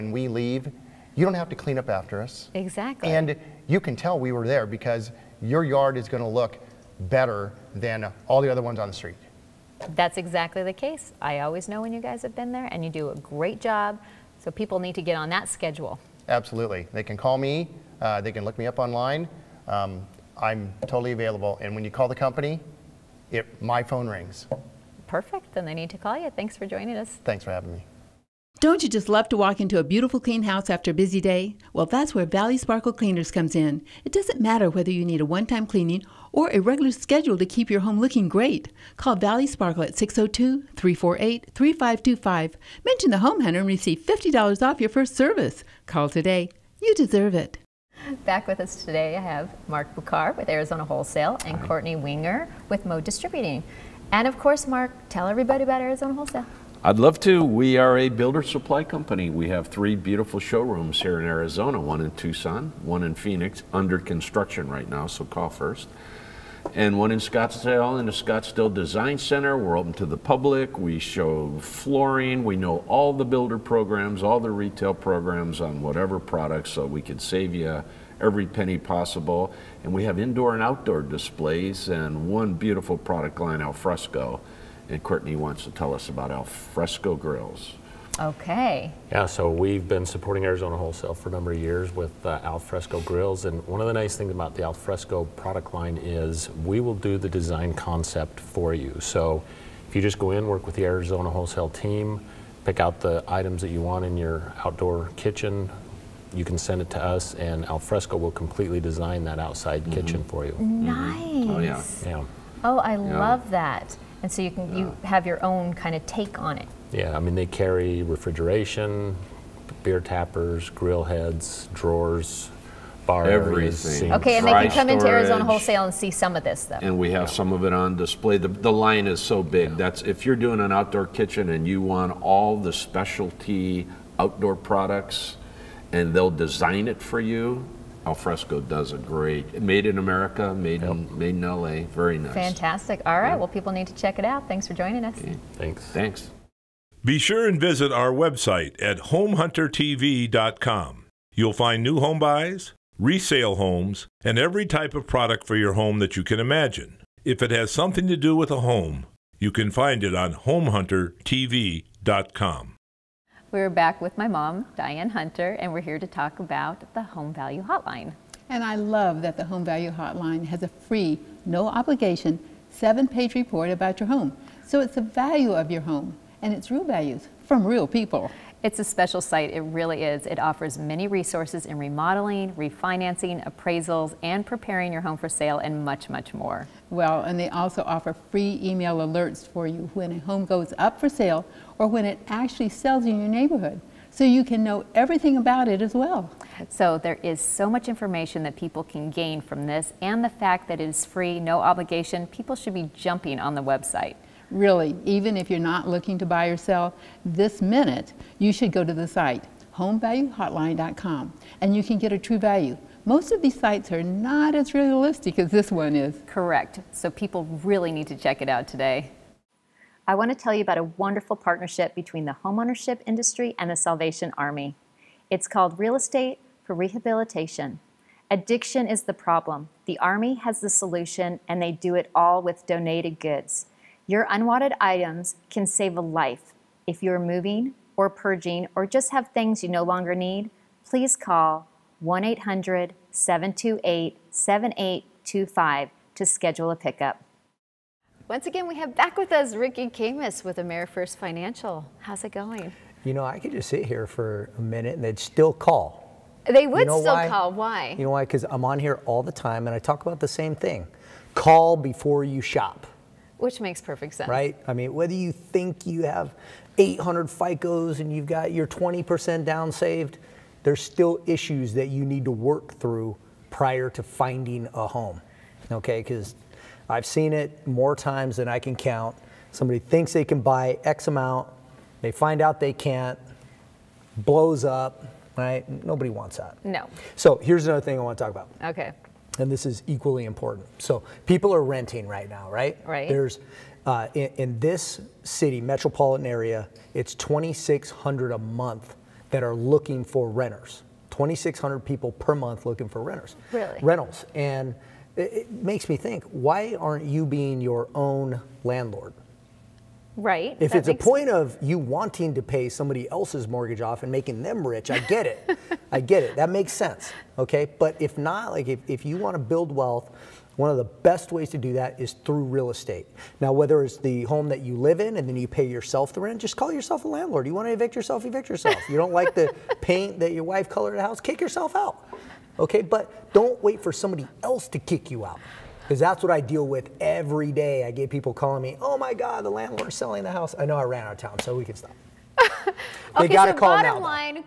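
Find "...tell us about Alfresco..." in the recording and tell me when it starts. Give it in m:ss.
1:25.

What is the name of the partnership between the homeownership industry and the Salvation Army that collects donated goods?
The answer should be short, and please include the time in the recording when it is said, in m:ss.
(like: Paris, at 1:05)
Real Estate for Rehabilitation, at 3:45.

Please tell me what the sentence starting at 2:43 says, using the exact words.
We're back with my mom, Diane Hunter, and we're here to talk about the Home Value Hotline.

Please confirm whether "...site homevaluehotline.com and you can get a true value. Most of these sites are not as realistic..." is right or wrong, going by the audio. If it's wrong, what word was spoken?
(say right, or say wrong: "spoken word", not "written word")
right.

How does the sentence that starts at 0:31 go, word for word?
Well, that's where Valley Sparkle Cleaners comes in.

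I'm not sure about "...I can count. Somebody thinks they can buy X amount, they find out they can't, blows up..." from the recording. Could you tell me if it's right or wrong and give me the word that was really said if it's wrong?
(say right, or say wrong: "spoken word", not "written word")
right.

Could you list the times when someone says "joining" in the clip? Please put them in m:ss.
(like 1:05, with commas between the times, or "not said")
0:26, 2:24.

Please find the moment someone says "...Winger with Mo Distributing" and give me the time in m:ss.
0:51.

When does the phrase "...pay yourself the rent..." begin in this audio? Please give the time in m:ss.
5:25.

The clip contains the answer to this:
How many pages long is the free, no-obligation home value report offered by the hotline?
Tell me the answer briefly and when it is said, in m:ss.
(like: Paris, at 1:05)
7, at 2:52.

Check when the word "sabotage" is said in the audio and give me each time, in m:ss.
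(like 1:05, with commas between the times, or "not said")
not said.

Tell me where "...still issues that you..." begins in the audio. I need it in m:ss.
4:30.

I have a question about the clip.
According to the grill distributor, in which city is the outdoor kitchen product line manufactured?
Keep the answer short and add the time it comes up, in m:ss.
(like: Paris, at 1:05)
LA, at 2:21.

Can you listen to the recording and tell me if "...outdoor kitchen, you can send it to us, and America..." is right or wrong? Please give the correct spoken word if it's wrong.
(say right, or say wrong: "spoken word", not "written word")
wrong: "Alfresco", not "America".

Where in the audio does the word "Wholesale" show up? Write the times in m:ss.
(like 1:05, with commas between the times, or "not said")
0:50, 0:56, 1:30, 1:41, 2:05.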